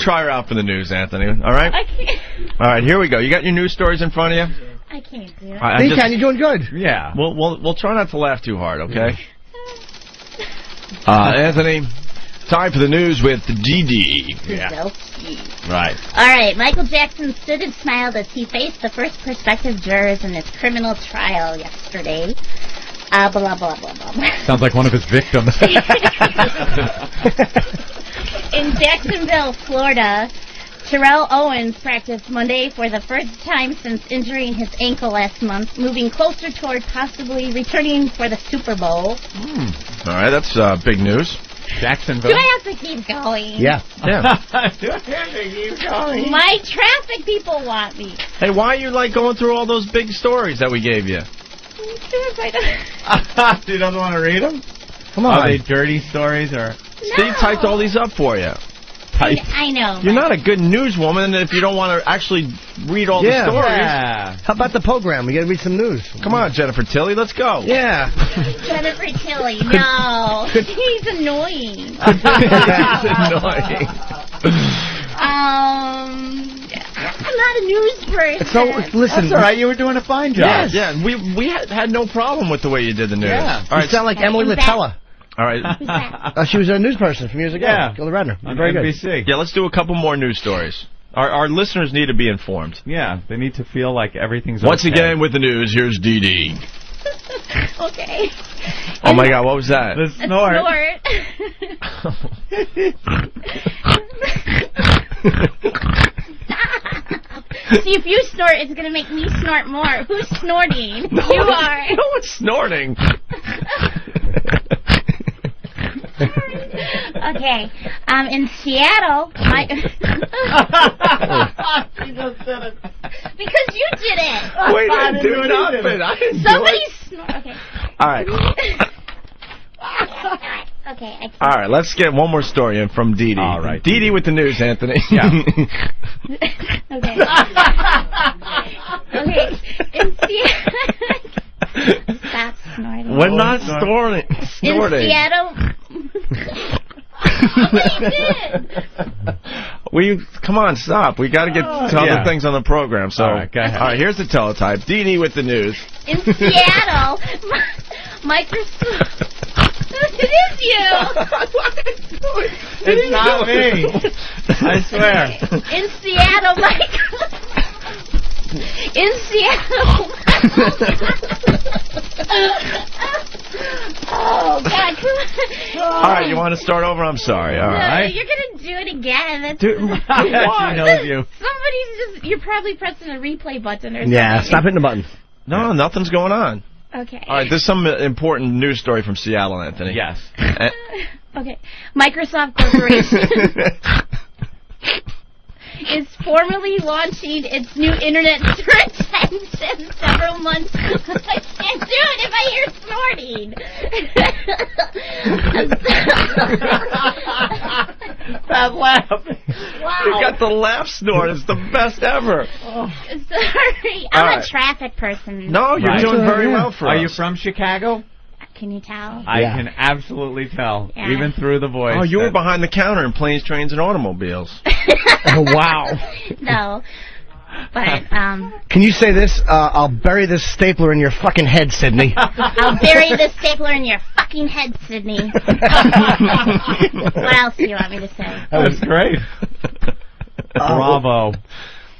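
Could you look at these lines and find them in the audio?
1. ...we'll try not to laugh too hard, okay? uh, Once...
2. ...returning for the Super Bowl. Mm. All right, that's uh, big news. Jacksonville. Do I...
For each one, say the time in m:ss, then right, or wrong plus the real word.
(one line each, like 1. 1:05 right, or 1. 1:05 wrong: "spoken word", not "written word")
1. 0:07 wrong: "Anthony", not "Once"
2. 0:37 right.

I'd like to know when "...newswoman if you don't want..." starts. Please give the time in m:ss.
1:00.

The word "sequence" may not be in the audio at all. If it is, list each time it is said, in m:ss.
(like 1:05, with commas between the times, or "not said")
not said.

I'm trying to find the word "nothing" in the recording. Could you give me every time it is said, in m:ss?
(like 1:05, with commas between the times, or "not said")
2:05, 3:05.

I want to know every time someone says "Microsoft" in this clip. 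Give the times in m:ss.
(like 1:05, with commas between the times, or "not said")
2:38, 2:46, 3:11.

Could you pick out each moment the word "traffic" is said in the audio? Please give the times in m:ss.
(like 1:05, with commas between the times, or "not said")
0:46, 3:34.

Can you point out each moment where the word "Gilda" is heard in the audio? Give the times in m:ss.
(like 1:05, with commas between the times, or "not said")
1:27.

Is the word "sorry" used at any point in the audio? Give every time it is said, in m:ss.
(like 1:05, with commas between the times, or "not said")
2:57, 3:33.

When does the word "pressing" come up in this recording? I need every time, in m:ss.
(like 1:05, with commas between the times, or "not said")
3:02.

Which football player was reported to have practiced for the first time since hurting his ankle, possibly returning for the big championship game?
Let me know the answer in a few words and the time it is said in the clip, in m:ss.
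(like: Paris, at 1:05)
Terrell Owens, at 0:30.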